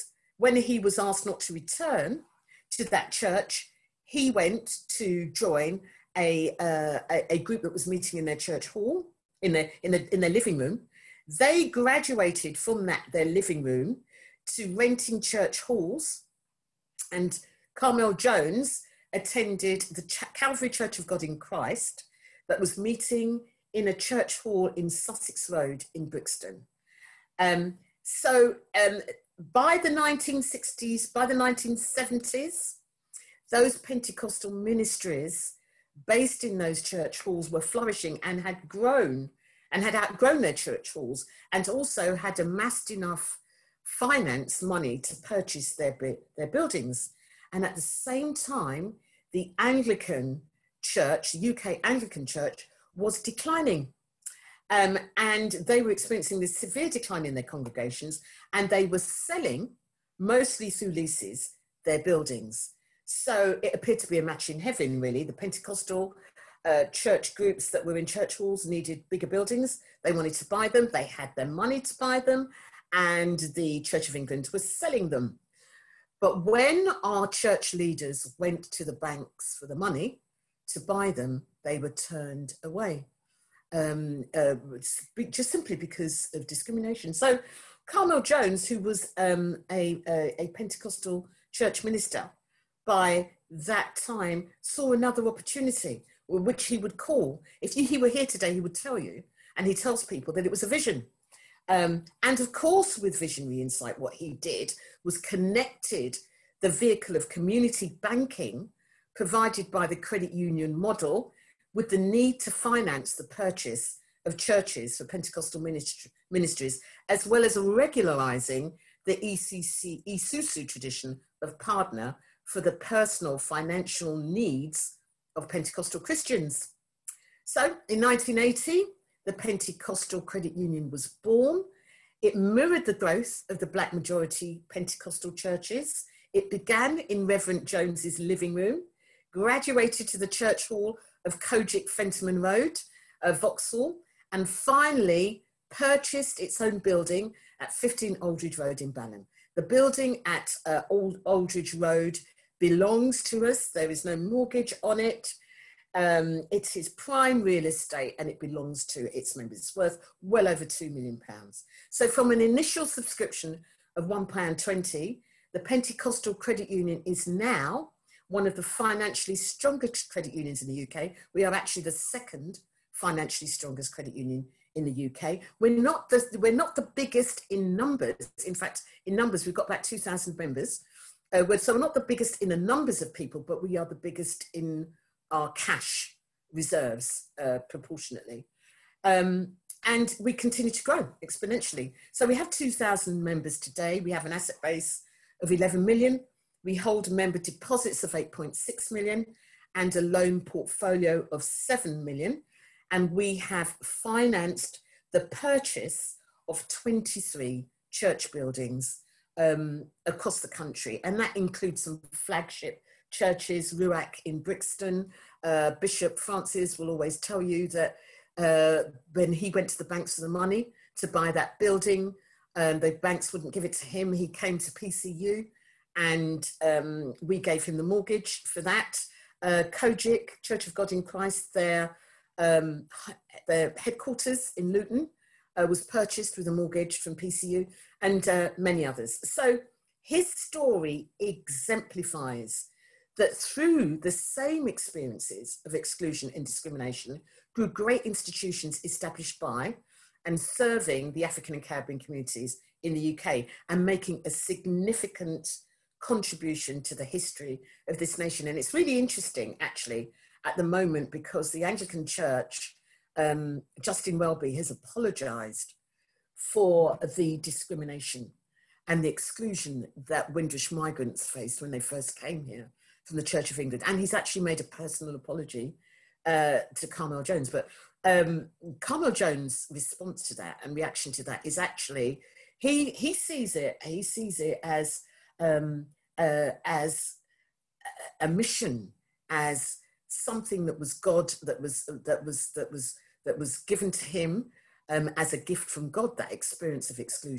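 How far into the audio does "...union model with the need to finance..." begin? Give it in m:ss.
1:50.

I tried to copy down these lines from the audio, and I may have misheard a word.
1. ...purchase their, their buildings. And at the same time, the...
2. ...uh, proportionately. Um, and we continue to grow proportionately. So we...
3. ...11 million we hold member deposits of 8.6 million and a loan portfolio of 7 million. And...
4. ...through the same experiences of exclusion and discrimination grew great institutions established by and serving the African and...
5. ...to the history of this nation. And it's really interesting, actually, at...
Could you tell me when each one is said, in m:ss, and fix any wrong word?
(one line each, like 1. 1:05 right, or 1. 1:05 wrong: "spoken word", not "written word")
1. 0:45 right
2. 3:07 wrong: "exponentially", not "proportionately"
3. 3:15 right
4. 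4:03 right
5. 4:16 right.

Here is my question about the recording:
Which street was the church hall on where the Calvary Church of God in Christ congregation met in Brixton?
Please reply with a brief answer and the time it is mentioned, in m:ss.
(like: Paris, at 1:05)
Sussex Road, at 0:24.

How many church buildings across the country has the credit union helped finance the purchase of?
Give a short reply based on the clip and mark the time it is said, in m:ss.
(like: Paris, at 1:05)
23, at 3:26.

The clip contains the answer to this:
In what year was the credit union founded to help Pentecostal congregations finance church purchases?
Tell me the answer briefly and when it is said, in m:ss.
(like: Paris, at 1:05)
1980, at 2:08.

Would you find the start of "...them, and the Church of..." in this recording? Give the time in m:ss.
1:12.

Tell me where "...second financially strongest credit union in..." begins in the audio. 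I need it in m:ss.
2:51.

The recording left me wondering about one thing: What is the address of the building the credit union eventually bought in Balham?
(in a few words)
15 Oldridge Road.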